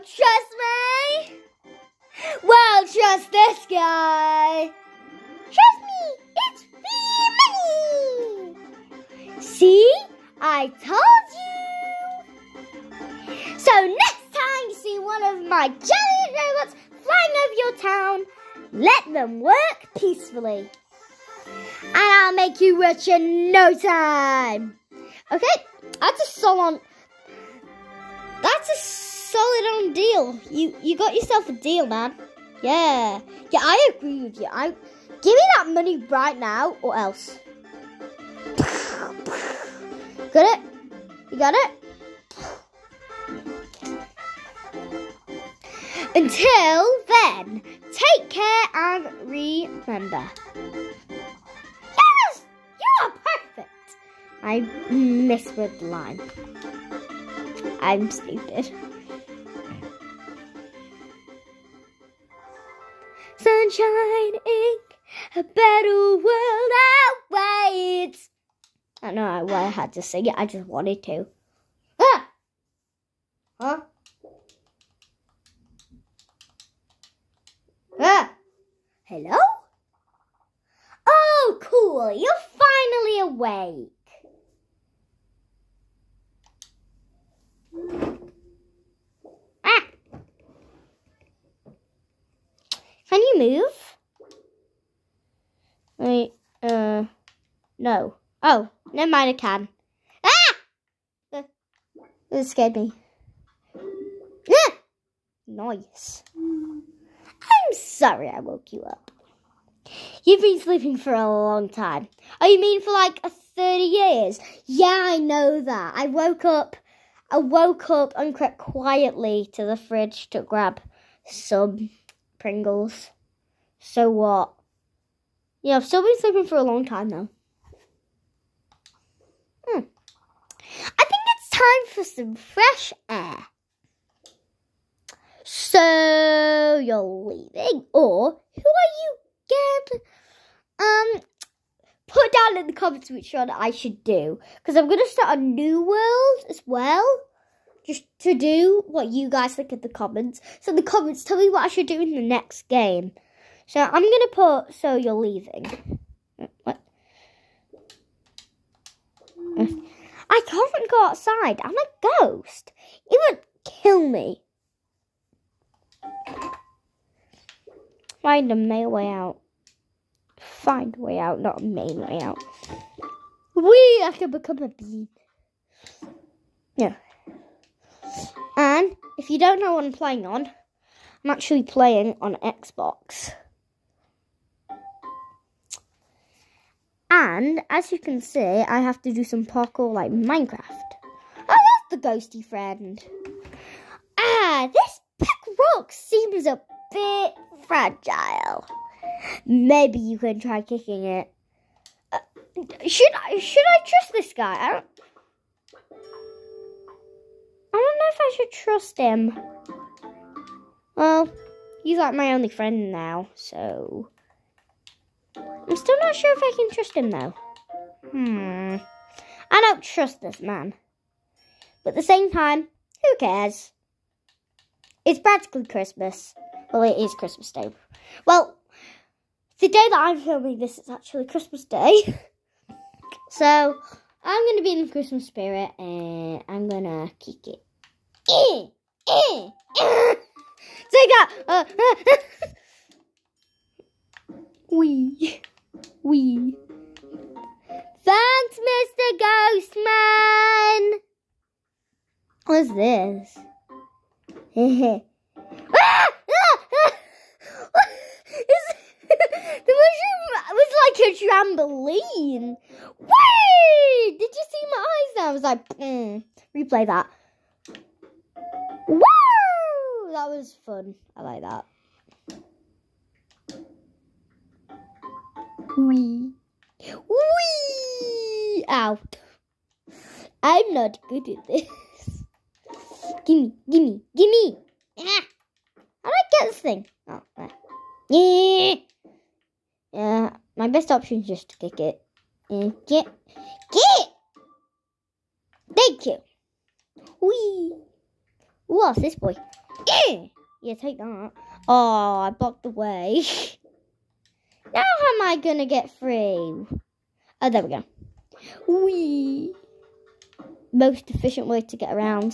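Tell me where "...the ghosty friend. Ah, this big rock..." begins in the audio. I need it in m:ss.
3:11.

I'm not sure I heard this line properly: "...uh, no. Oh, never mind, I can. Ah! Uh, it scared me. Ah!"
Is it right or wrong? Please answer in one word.
right.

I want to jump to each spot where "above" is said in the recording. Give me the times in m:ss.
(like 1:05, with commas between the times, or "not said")
not said.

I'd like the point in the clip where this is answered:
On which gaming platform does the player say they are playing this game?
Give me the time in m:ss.
3:02.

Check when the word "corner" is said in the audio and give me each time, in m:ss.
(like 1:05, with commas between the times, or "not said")
not said.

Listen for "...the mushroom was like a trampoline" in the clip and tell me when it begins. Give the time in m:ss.
4:19.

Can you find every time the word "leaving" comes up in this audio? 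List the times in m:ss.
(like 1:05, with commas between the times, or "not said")
2:17, 2:35.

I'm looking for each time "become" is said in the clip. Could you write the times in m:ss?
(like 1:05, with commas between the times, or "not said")
2:54.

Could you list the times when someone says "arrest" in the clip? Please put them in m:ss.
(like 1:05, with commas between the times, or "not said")
not said.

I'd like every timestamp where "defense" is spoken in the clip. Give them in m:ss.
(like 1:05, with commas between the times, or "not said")
not said.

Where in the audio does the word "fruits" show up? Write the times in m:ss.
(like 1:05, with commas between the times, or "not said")
not said.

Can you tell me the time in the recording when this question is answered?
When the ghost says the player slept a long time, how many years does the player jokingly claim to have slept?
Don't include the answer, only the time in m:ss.
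1:53.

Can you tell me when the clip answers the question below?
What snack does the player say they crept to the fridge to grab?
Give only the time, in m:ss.
2:02.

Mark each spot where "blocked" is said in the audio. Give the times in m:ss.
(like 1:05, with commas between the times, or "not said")
5:02.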